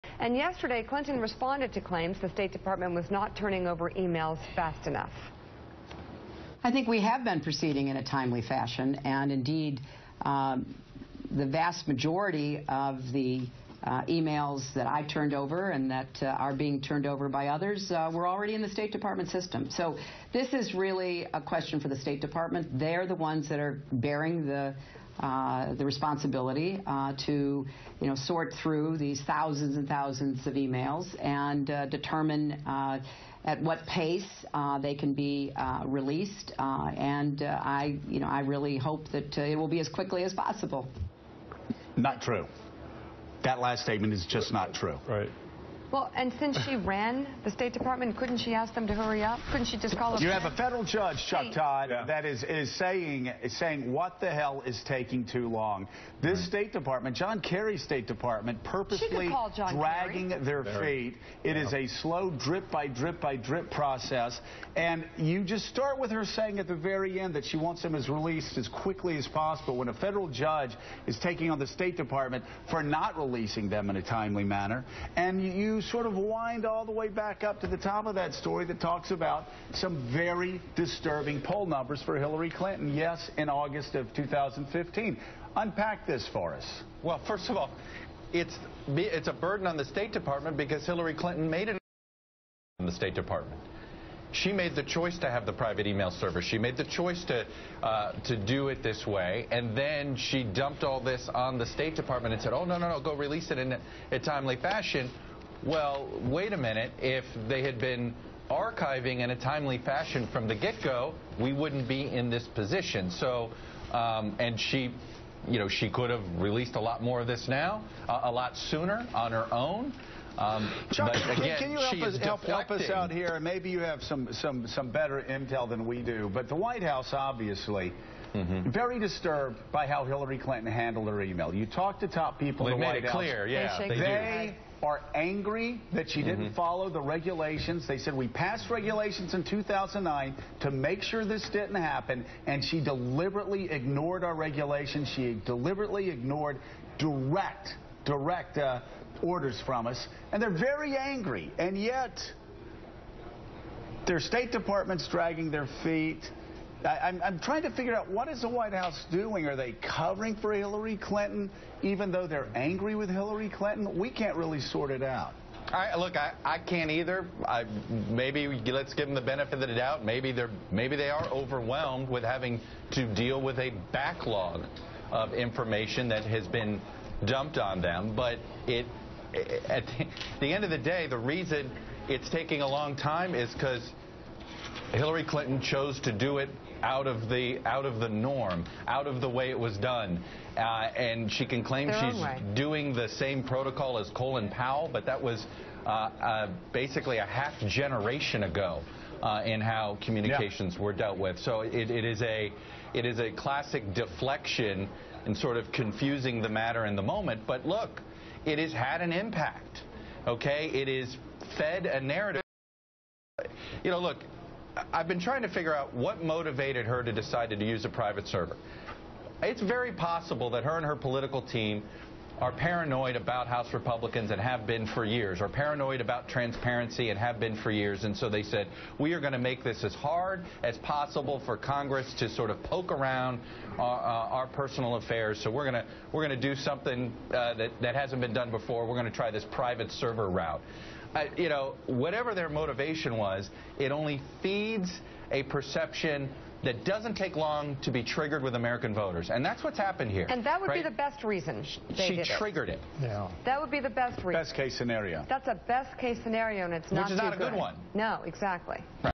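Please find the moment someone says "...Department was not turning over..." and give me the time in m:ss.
0:02.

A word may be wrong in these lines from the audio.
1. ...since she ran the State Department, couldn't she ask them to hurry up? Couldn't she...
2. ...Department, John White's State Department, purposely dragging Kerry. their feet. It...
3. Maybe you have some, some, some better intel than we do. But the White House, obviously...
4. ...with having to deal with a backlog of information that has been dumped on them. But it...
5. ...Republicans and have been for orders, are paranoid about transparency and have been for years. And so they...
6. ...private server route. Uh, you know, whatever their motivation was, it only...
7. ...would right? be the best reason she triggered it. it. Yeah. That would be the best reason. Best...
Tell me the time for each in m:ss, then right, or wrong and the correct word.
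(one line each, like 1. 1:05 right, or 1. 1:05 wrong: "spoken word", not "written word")
1. 0:46 right
2. 0:56 wrong: "Kerry", not "White"
3. 2:03 right
4. 2:52 right
5. 3:43 wrong: "years", not "orders"
6. 3:59 right
7. 4:10 right.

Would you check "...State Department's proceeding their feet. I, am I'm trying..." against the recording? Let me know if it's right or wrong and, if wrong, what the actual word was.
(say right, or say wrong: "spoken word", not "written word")
wrong: "dragging", not "proceeding".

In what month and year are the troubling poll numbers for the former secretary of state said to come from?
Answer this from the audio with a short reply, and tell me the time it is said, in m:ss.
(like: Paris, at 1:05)
August 2015, at 1:23.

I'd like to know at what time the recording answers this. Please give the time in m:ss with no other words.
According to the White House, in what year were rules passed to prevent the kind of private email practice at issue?
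2:19.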